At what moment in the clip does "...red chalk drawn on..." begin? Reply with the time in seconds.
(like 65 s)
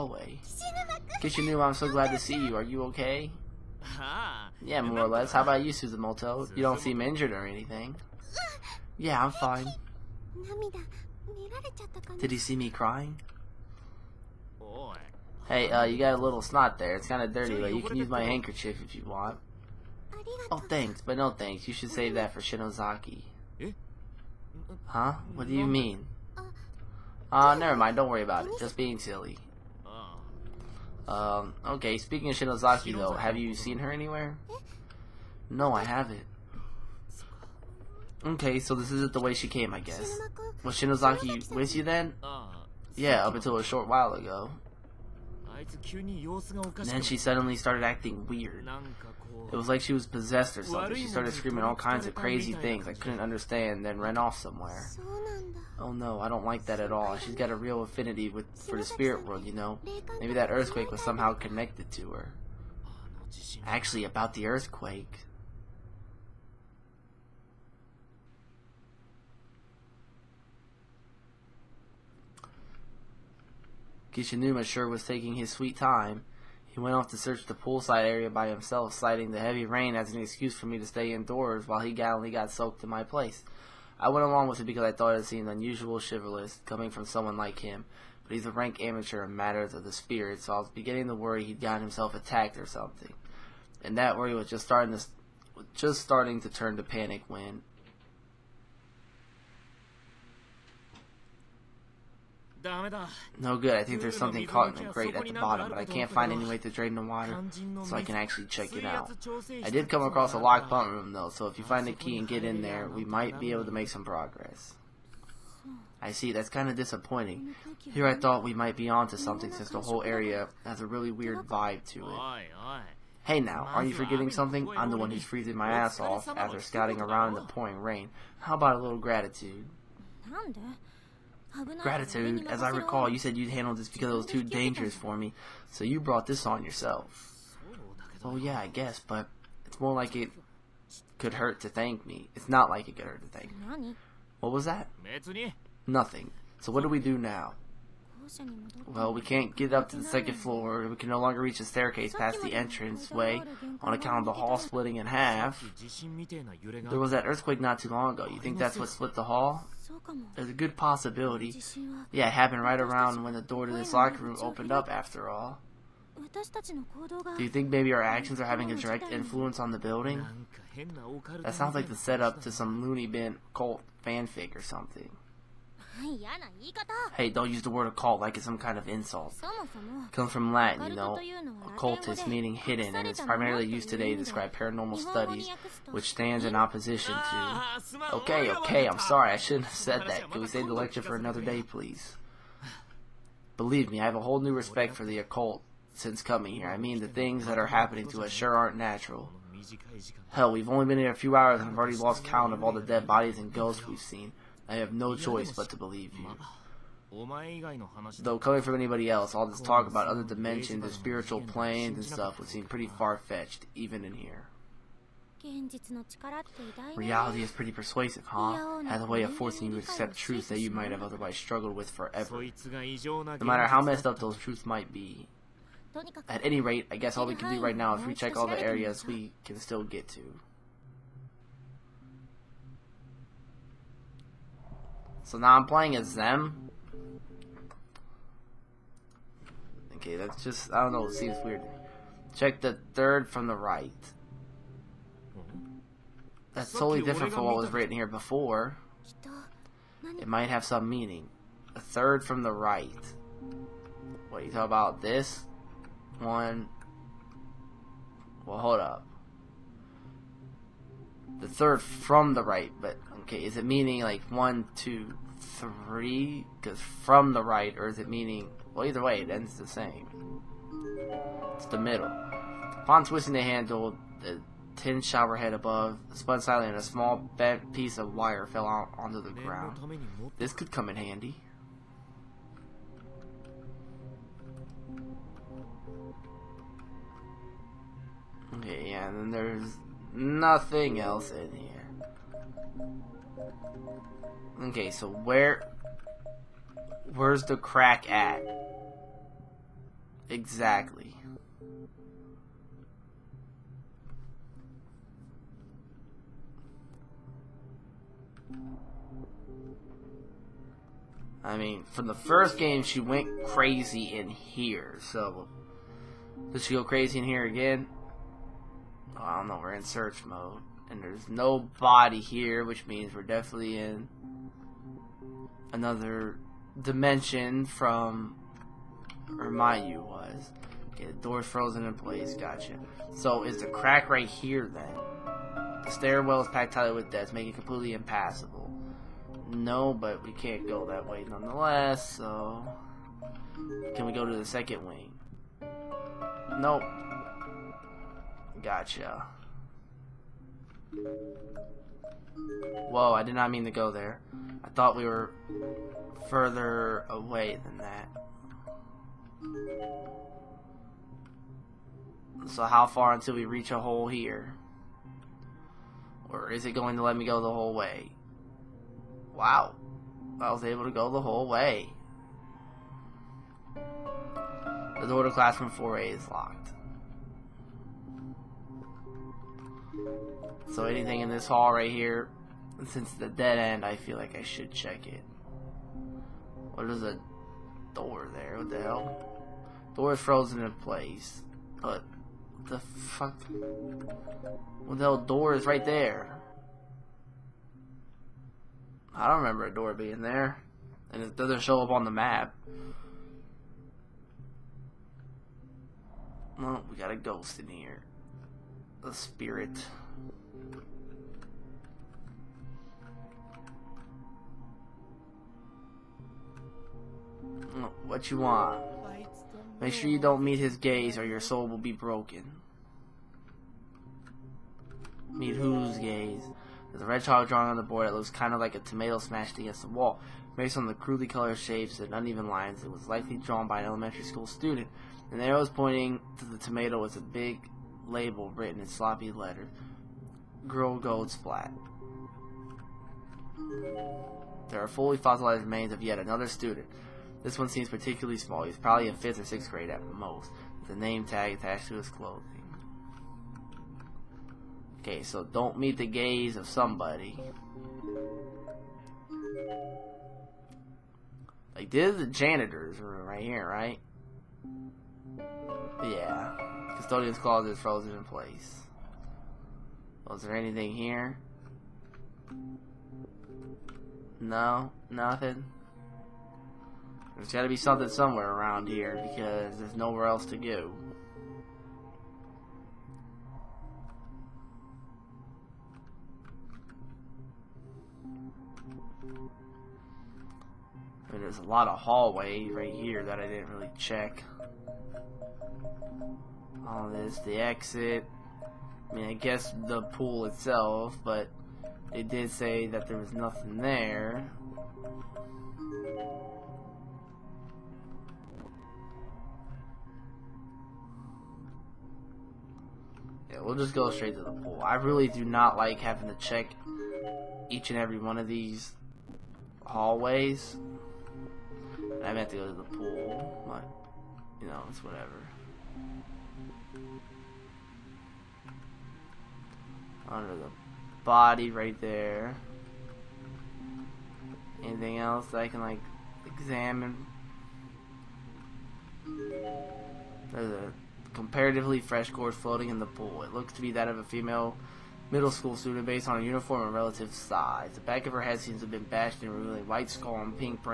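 427 s.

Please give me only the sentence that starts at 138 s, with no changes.
Oh yeah, I guess, but it's more like it could hurt to thank me.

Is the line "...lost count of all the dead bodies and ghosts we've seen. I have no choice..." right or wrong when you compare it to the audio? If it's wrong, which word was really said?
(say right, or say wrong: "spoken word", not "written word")
right.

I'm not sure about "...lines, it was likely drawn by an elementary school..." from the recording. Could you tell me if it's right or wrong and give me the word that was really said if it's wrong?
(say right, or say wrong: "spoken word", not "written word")
right.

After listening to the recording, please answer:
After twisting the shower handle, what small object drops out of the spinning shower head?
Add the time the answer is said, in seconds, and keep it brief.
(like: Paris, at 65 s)
bent piece of wire, at 276 s.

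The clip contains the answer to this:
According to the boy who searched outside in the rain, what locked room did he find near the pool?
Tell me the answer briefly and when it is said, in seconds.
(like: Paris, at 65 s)
pump room, at 110 s.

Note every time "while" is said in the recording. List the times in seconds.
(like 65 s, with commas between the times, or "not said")
43 s, 81 s.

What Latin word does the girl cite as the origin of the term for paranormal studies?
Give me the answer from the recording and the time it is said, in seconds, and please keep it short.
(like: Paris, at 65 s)
occultus, at 181 s.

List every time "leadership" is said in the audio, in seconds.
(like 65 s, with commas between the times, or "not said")
not said.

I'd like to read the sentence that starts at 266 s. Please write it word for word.
Because from the right, or is it meaning?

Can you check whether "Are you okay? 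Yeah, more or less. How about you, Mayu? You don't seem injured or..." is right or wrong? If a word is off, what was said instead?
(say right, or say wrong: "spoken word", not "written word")
wrong: "Suzumoto", not "Mayu".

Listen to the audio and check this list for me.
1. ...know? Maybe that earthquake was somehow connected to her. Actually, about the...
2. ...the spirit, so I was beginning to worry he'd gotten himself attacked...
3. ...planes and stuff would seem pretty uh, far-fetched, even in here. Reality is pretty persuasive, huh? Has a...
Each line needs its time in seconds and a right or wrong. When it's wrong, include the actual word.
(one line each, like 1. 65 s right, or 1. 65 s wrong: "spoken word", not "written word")
1. 59 s right
2. 89 s right
3. 211 s right.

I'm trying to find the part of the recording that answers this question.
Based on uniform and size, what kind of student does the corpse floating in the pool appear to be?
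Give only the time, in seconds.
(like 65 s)
545 s.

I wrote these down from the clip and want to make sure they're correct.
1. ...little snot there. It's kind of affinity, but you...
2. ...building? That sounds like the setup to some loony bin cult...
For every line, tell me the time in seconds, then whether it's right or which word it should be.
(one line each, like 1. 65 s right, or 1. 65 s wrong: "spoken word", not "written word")
1. 16 s wrong: "dirty", not "affinity"
2. 169 s right.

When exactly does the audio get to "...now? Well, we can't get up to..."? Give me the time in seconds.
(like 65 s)
147 s.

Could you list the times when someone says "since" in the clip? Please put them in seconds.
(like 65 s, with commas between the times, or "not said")
119 s, 195 s, 382 s.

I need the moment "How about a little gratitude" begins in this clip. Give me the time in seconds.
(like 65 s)
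128 s.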